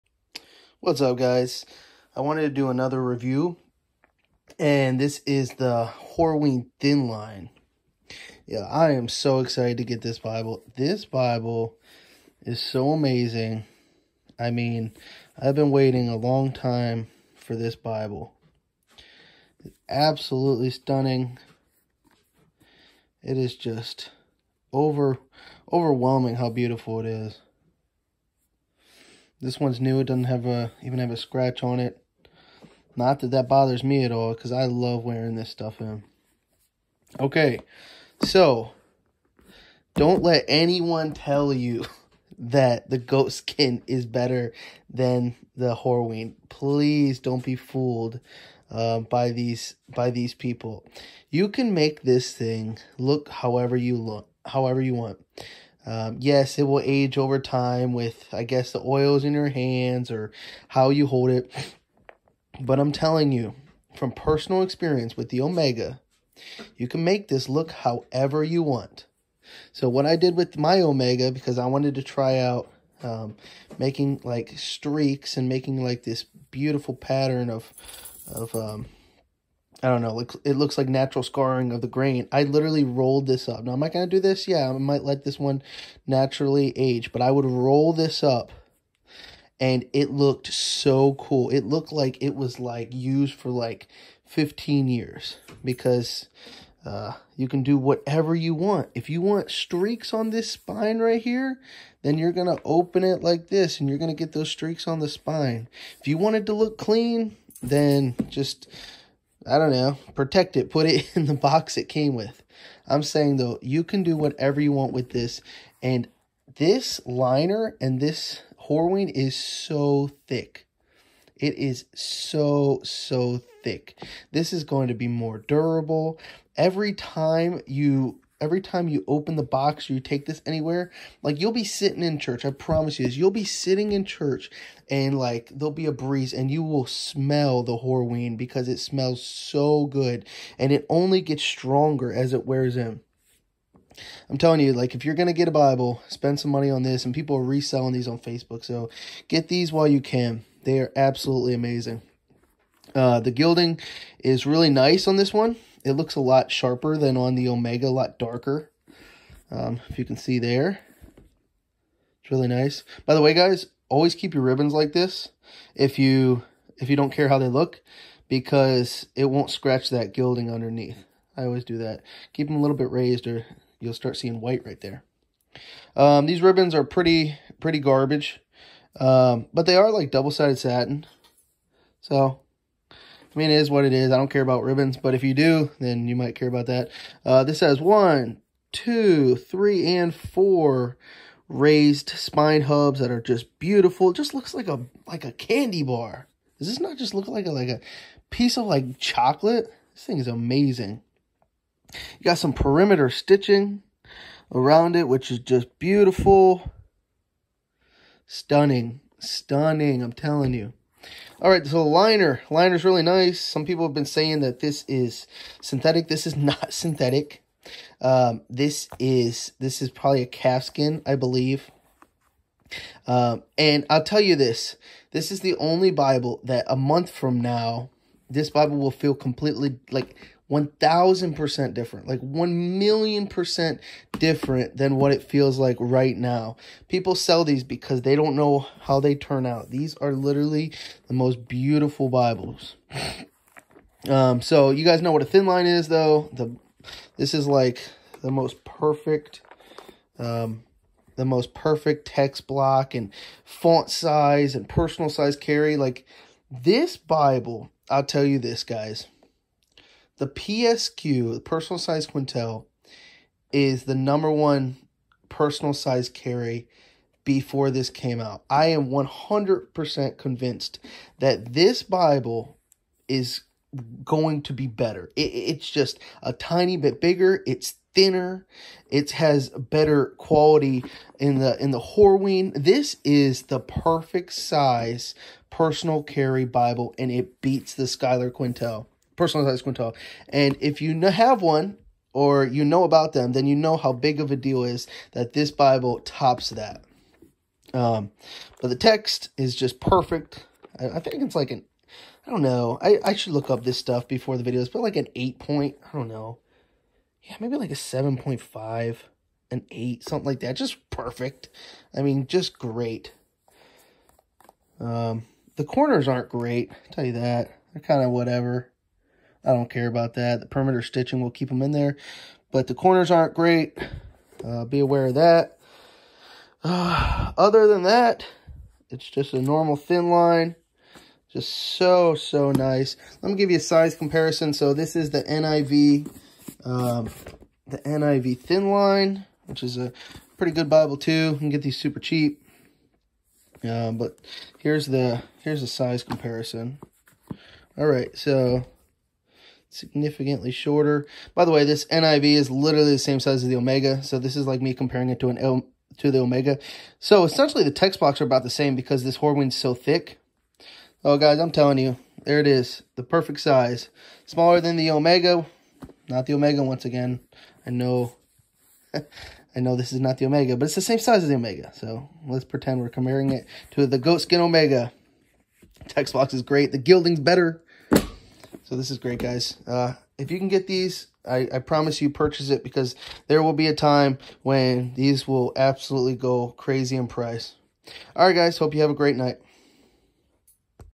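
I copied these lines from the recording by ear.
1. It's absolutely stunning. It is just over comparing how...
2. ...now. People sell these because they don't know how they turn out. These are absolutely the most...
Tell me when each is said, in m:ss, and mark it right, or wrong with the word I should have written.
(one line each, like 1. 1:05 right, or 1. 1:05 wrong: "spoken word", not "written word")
1. 0:19 wrong: "overwhelming", not "comparing"
2. 3:56 wrong: "literally", not "absolutely".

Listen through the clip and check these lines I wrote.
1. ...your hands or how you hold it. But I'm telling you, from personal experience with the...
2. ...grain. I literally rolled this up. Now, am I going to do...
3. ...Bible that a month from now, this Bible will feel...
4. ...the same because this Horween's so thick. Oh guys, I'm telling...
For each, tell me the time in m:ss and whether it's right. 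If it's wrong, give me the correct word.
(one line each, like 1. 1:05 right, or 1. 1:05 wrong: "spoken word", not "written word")
1. 0:59 right
2. 1:21 right
3. 3:45 right
4. 5:58 right.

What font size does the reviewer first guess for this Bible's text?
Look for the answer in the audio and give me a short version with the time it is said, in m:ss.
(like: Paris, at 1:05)
8 point, at 5:05.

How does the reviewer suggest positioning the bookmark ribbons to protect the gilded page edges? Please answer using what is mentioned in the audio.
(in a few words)
a little bit raised.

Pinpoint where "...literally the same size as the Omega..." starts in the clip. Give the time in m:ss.
5:52.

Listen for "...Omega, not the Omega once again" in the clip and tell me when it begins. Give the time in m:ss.
6:04.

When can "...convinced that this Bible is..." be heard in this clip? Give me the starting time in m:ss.
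4:30.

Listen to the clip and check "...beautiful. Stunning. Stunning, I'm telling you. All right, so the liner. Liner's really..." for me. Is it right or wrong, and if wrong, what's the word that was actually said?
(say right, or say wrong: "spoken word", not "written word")
right.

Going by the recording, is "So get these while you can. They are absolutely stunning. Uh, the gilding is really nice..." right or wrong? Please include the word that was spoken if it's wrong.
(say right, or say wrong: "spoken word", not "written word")
wrong: "amazing", not "stunning".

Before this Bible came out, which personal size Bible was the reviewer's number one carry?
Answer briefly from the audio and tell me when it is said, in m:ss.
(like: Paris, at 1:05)
personal size Quentel, at 4:21.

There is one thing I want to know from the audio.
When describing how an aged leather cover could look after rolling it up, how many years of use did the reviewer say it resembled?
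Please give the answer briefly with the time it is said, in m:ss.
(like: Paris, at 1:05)
15, at 1:34.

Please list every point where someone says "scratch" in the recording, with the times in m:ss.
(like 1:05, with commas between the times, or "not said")
0:31, 2:49.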